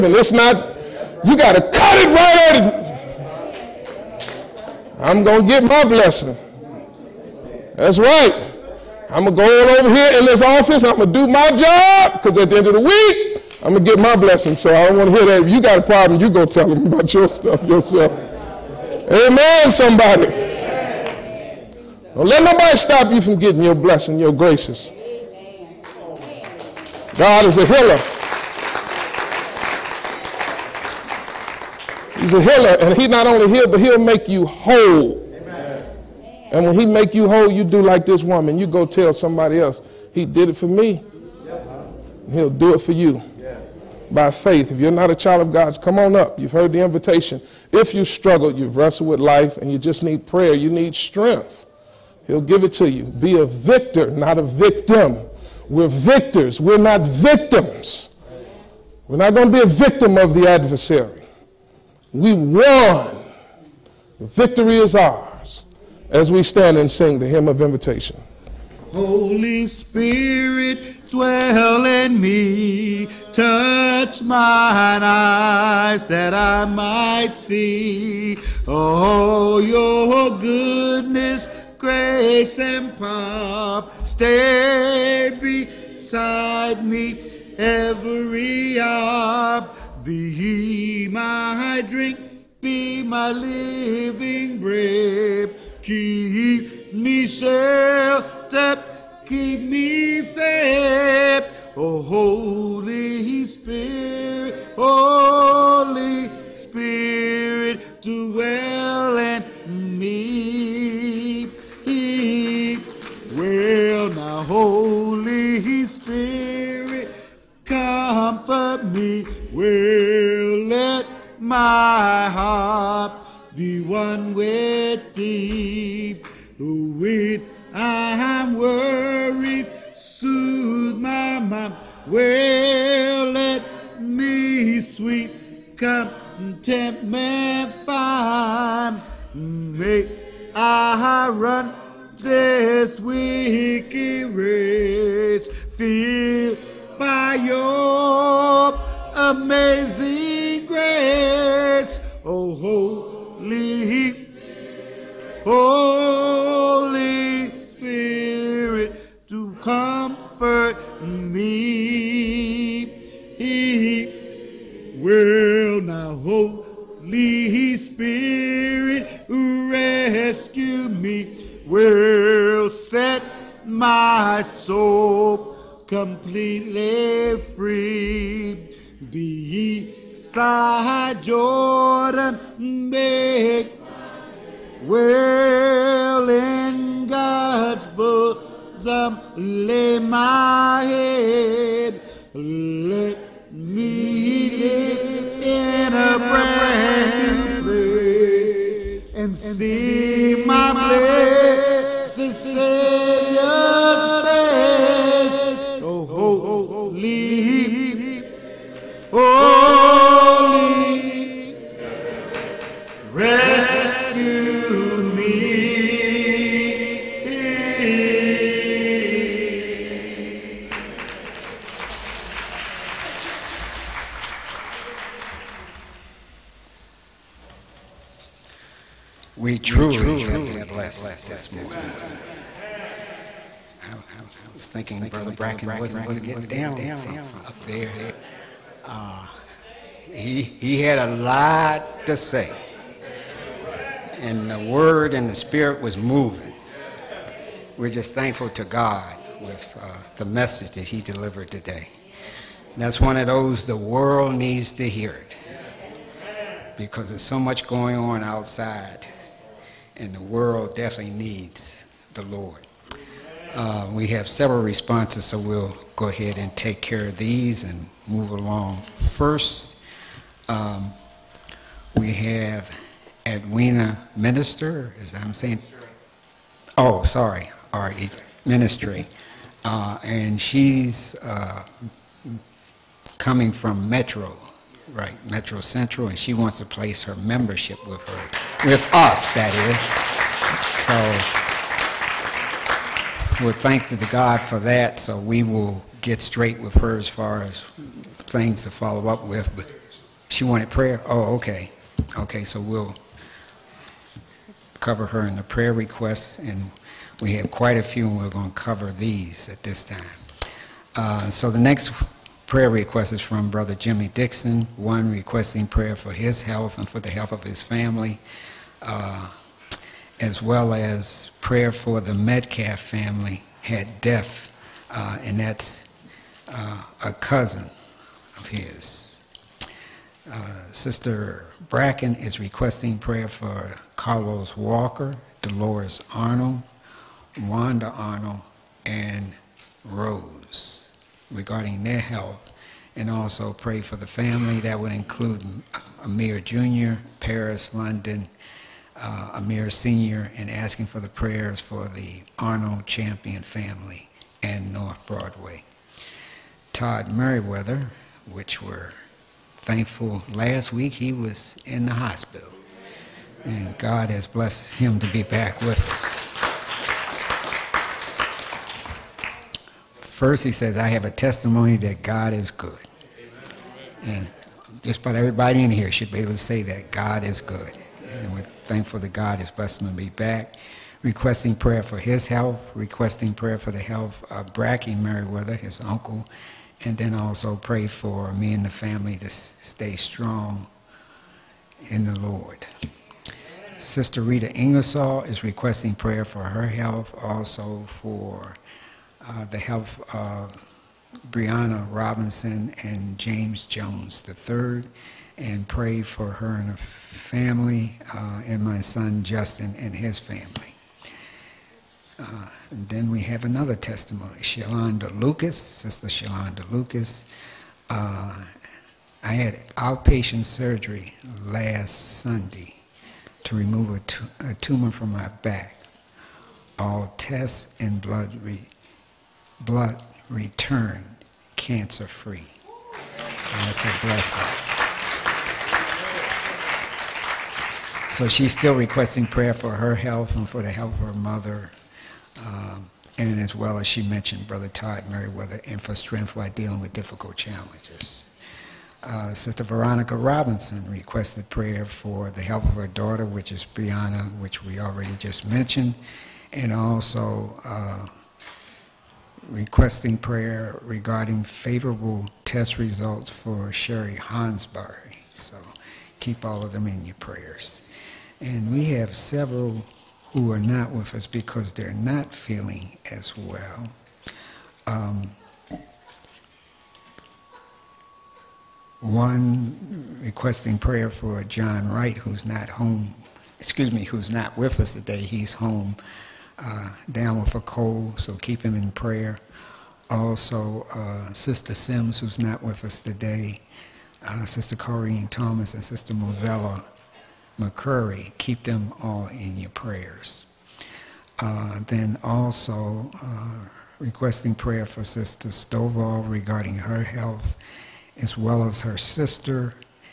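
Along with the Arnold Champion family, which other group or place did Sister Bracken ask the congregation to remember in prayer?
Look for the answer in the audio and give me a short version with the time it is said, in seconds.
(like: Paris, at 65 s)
North Broadway, at 354 s.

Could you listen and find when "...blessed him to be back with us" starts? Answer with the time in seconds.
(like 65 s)
364 s.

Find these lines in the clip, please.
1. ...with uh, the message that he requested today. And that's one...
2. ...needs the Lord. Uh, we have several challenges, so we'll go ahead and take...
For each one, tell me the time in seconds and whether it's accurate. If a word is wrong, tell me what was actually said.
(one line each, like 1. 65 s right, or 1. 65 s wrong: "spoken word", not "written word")
1. 249 s wrong: "delivered", not "requested"
2. 261 s wrong: "responses", not "challenges".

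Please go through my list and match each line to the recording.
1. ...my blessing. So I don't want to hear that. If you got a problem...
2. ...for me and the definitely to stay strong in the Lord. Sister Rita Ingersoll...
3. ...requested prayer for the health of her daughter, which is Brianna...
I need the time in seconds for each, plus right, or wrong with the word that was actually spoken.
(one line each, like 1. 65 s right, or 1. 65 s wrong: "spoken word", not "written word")
1. 13 s right
2. 387 s wrong: "family", not "definitely"
3. 450 s right.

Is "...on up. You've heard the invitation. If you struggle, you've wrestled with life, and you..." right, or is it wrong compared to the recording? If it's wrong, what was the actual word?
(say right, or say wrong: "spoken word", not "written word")
right.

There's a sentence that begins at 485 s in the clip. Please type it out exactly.
He's home uh, down with a cold, so keep him in prayer.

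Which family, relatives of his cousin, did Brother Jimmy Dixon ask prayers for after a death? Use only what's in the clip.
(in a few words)
Metcalf.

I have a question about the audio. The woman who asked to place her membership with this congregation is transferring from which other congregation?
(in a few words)
Metro Central.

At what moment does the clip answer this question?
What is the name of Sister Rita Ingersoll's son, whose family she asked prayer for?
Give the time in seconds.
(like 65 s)
409 s.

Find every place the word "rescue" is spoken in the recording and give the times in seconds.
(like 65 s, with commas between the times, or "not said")
169 s, 213 s.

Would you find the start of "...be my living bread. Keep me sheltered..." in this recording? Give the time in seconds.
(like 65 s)
92 s.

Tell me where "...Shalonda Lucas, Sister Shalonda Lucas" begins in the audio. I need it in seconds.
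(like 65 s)
414 s.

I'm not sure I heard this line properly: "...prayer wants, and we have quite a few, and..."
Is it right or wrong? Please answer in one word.
wrong.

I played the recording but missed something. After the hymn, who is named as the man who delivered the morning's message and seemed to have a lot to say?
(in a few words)
Brother Bracken.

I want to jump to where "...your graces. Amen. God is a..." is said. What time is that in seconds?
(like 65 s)
24 s.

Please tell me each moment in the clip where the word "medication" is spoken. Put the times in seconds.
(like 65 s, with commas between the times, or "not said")
not said.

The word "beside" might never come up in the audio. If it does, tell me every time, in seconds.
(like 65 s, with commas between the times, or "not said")
85 s, 179 s.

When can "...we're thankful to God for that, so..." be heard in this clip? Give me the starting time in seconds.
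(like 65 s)
293 s.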